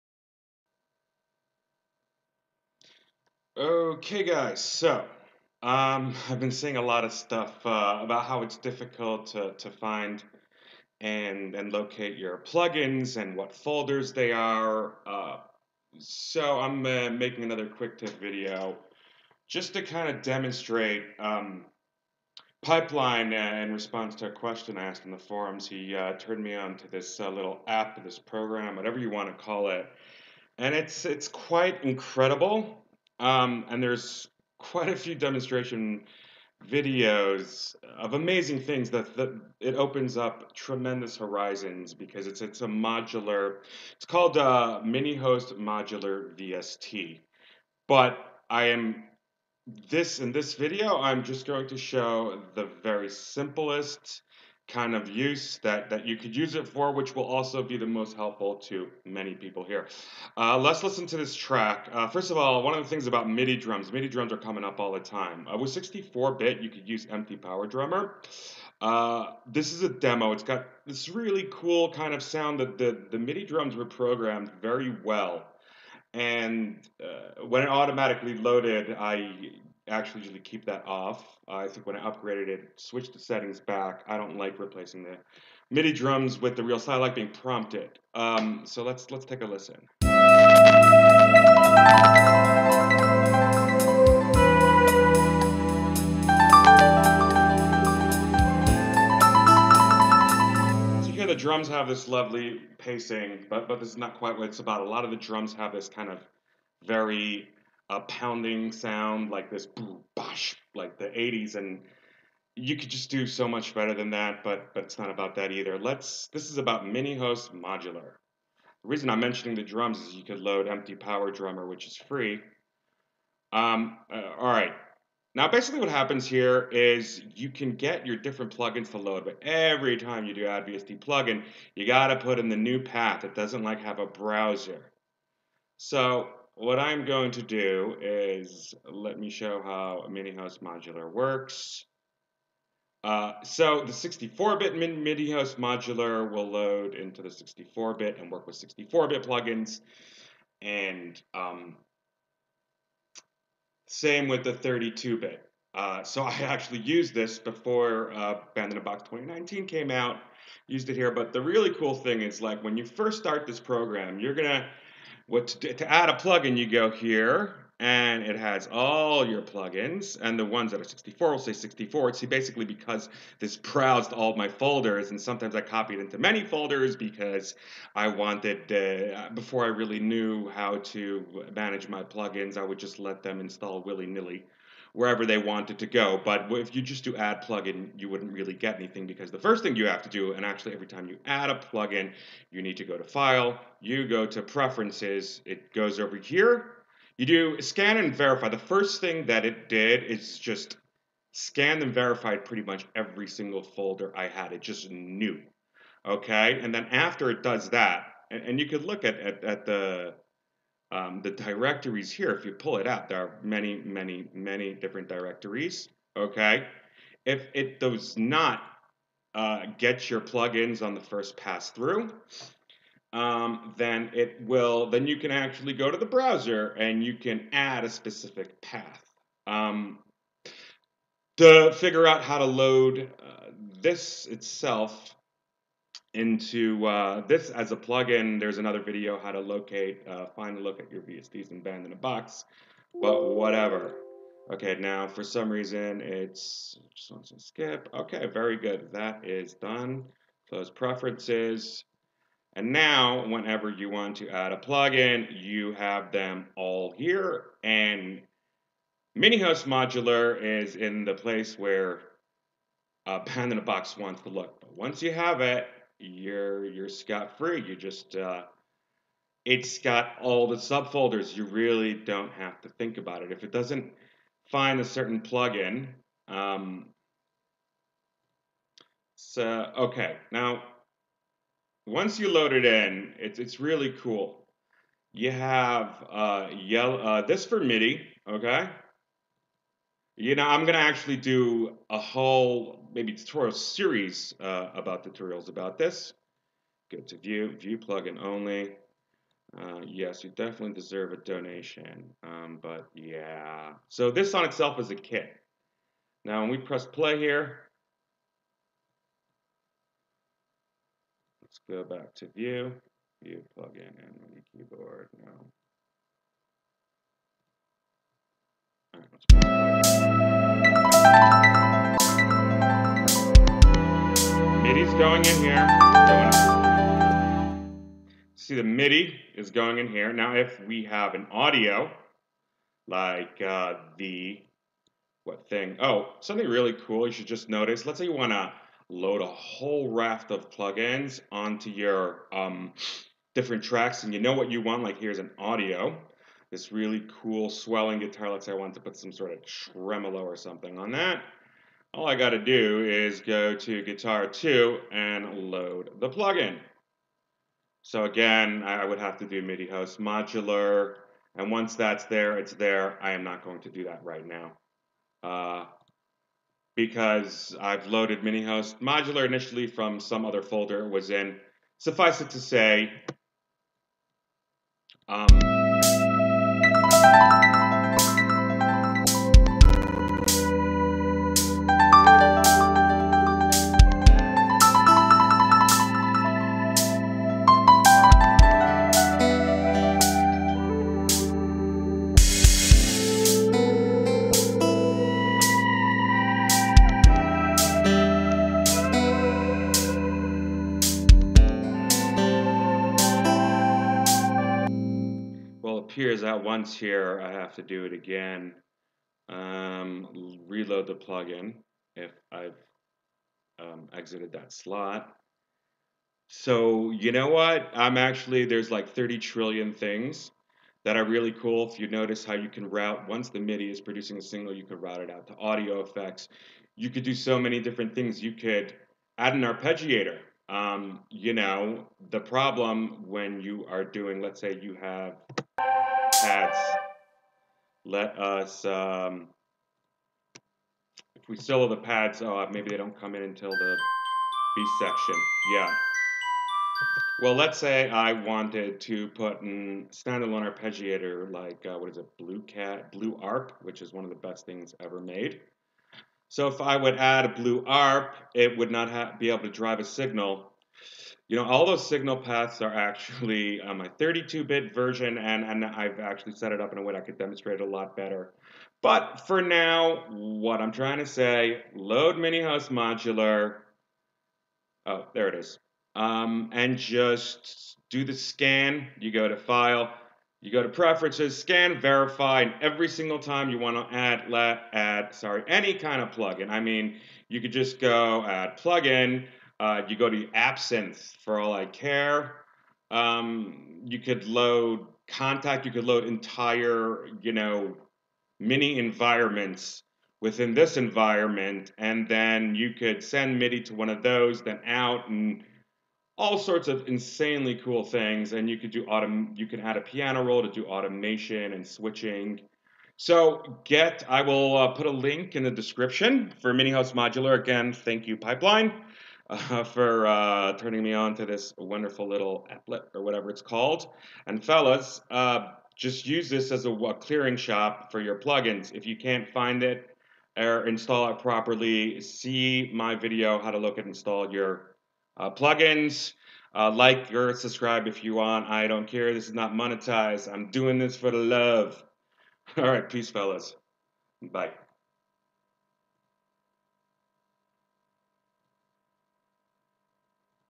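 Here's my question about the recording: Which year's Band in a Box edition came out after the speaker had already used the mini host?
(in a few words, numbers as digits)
2019.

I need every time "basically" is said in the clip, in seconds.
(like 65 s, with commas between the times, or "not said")
125 s, 172 s.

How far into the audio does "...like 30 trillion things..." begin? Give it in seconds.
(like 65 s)
418 s.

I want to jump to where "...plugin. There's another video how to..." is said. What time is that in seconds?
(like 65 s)
237 s.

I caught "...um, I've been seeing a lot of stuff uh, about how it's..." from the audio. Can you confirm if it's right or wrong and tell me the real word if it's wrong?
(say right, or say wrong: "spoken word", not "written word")
right.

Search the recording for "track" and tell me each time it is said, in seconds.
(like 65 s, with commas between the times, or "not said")
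61 s, 343 s.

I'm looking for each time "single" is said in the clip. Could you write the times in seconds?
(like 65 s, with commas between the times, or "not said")
203 s, 482 s.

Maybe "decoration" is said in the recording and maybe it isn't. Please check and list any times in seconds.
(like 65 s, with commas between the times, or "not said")
not said.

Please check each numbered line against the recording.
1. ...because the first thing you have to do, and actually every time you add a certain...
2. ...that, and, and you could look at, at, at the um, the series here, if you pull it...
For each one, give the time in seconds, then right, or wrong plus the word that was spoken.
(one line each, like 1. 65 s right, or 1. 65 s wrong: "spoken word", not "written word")
1. 189 s wrong: "plugin", not "certain"
2. 207 s wrong: "directories", not "series".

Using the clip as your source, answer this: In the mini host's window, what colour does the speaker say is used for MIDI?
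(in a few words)
Yellow.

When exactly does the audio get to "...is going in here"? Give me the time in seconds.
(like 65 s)
329 s.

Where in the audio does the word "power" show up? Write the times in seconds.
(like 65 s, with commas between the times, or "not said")
67 s, 120 s.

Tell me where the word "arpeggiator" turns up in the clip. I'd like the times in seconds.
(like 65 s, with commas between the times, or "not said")
429 s, 450 s.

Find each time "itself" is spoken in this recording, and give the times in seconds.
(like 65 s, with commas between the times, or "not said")
234 s, 304 s.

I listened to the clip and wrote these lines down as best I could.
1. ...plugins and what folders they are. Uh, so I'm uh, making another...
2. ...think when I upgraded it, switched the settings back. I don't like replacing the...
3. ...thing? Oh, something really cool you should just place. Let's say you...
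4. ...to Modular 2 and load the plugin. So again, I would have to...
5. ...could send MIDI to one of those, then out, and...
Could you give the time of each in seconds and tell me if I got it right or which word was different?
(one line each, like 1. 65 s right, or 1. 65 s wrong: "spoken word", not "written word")
1. 12 s right
2. 81 s right
3. 335 s wrong: "notice", not "place"
4. 353 s wrong: "Guitar", not "Modular"
5. 502 s right.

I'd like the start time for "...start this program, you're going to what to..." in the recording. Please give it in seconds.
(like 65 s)
163 s.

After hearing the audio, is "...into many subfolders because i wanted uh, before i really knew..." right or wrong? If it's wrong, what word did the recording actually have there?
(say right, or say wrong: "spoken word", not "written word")
wrong: "folders", not "subfolders".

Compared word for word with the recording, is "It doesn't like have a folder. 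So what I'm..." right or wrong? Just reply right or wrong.
wrong.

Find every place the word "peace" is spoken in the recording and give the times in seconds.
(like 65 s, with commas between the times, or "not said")
542 s.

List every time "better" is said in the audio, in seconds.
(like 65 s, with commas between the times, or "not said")
113 s, 467 s.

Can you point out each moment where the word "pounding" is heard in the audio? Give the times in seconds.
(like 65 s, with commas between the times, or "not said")
107 s.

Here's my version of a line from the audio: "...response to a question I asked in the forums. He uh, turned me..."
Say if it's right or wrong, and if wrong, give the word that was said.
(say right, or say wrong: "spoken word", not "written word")
right.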